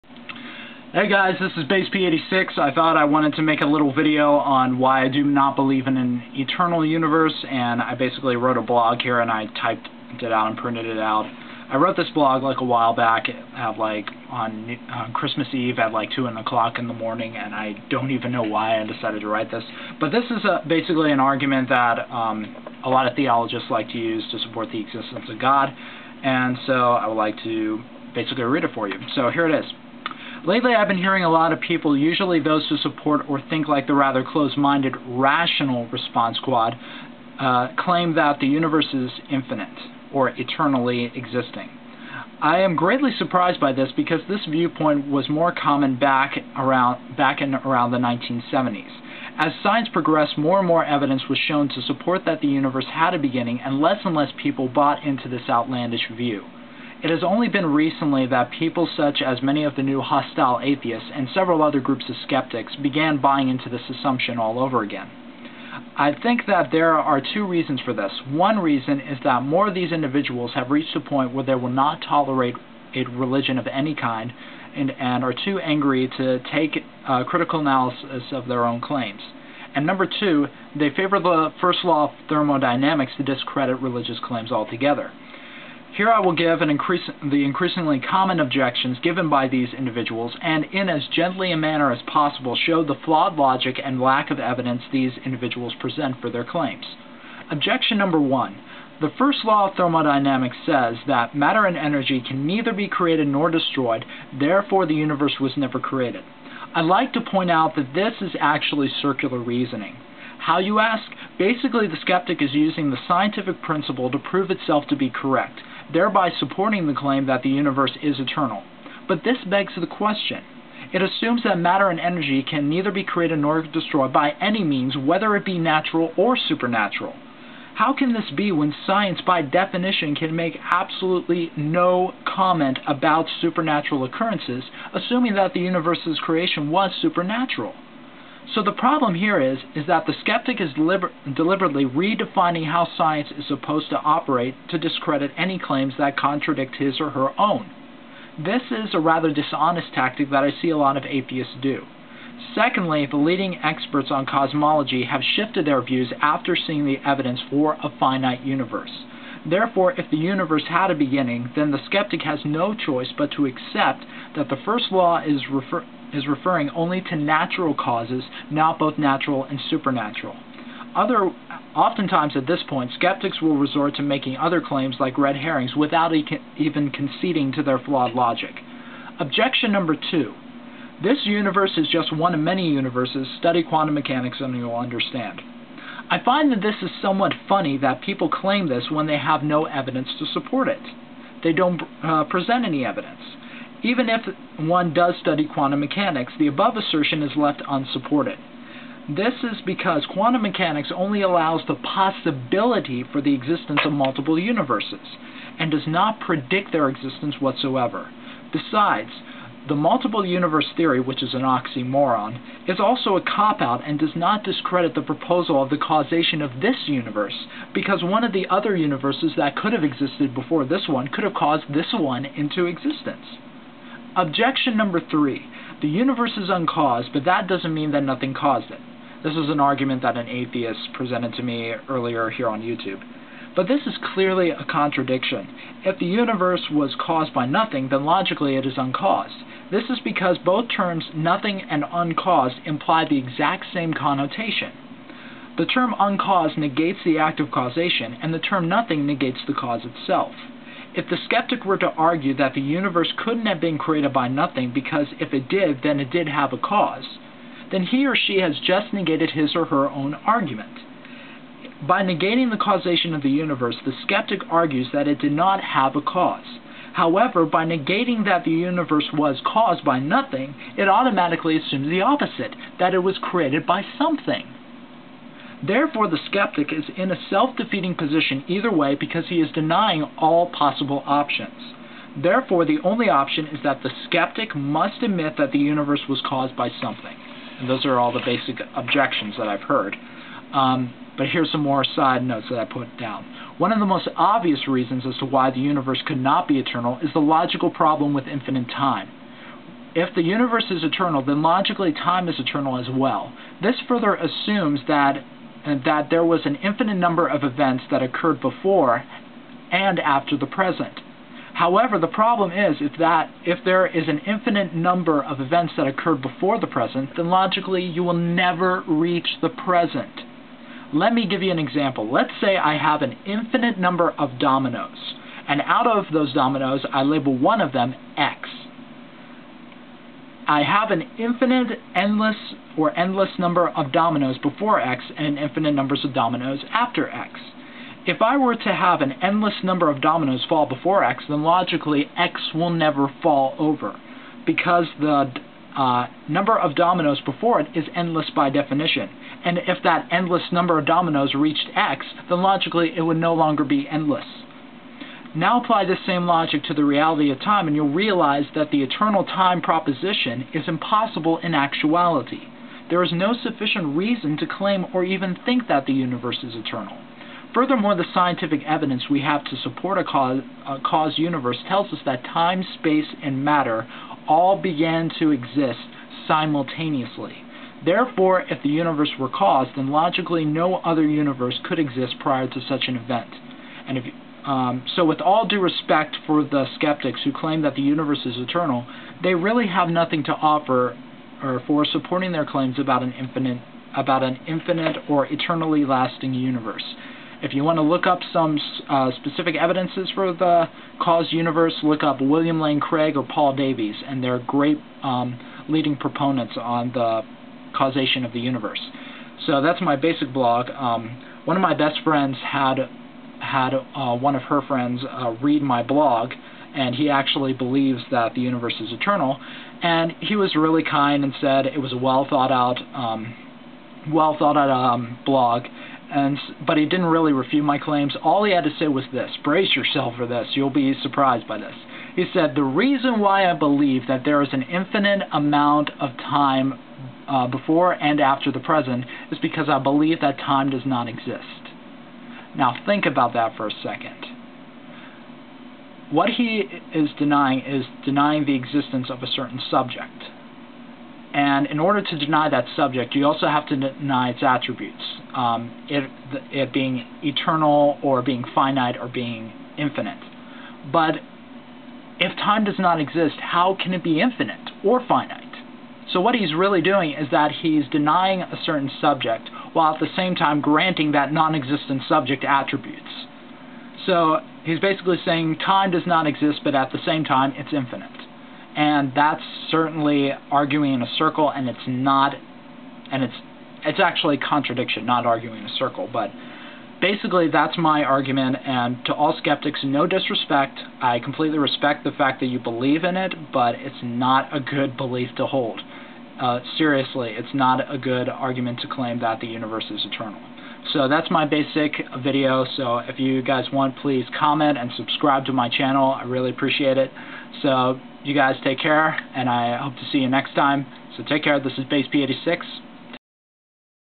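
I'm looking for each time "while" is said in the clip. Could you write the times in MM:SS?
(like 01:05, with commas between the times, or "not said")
00:12, 07:49.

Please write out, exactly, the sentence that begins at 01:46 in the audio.
I'd like to point out that this is actually circular reasoning.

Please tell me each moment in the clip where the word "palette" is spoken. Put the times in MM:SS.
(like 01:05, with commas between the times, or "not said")
not said.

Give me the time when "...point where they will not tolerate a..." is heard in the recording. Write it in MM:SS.
01:10.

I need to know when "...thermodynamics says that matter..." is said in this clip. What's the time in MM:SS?
01:39.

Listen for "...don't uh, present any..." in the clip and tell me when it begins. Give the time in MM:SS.
03:11.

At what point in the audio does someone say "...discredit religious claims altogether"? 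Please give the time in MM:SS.
01:23.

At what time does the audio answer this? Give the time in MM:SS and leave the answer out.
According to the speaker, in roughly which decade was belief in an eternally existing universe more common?
00:47.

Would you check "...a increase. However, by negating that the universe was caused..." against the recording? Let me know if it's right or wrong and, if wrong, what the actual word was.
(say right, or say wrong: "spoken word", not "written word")
wrong: "cause", not "increase".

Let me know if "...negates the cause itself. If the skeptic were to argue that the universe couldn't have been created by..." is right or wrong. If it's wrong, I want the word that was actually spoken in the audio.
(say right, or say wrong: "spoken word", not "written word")
right.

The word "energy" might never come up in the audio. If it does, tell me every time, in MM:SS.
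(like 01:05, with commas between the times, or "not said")
01:41, 02:01.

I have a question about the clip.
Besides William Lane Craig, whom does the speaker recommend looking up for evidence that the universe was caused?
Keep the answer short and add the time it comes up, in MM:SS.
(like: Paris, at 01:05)
Paul Davies, at 06:43.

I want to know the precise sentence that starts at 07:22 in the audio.
Now think about that for a second.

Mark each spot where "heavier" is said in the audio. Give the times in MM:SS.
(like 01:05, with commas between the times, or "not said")
not said.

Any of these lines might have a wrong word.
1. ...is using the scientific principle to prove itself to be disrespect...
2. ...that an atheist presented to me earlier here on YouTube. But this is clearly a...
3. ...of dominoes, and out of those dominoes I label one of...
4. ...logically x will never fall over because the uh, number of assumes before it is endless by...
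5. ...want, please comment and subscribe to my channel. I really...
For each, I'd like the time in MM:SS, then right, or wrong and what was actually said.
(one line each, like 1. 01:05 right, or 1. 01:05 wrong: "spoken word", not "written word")
1. 01:52 wrong: "correct", not "disrespect"
2. 03:50 right
3. 05:24 right
4. 05:41 wrong: "dominoes", not "assumes"
5. 08:23 right.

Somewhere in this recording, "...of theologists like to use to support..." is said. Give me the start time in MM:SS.
00:23.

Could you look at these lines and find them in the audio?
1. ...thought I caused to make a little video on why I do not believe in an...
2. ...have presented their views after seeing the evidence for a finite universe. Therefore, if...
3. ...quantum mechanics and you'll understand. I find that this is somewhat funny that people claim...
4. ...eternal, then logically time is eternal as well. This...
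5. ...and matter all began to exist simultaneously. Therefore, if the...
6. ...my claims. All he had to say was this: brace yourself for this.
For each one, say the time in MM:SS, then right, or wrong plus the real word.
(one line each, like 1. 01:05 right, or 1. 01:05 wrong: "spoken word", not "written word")
1. 00:02 wrong: "wanted", not "caused"
2. 02:35 wrong: "shifted", not "presented"
3. 03:03 right
4. 05:00 right
5. 06:13 right
6. 07:07 right.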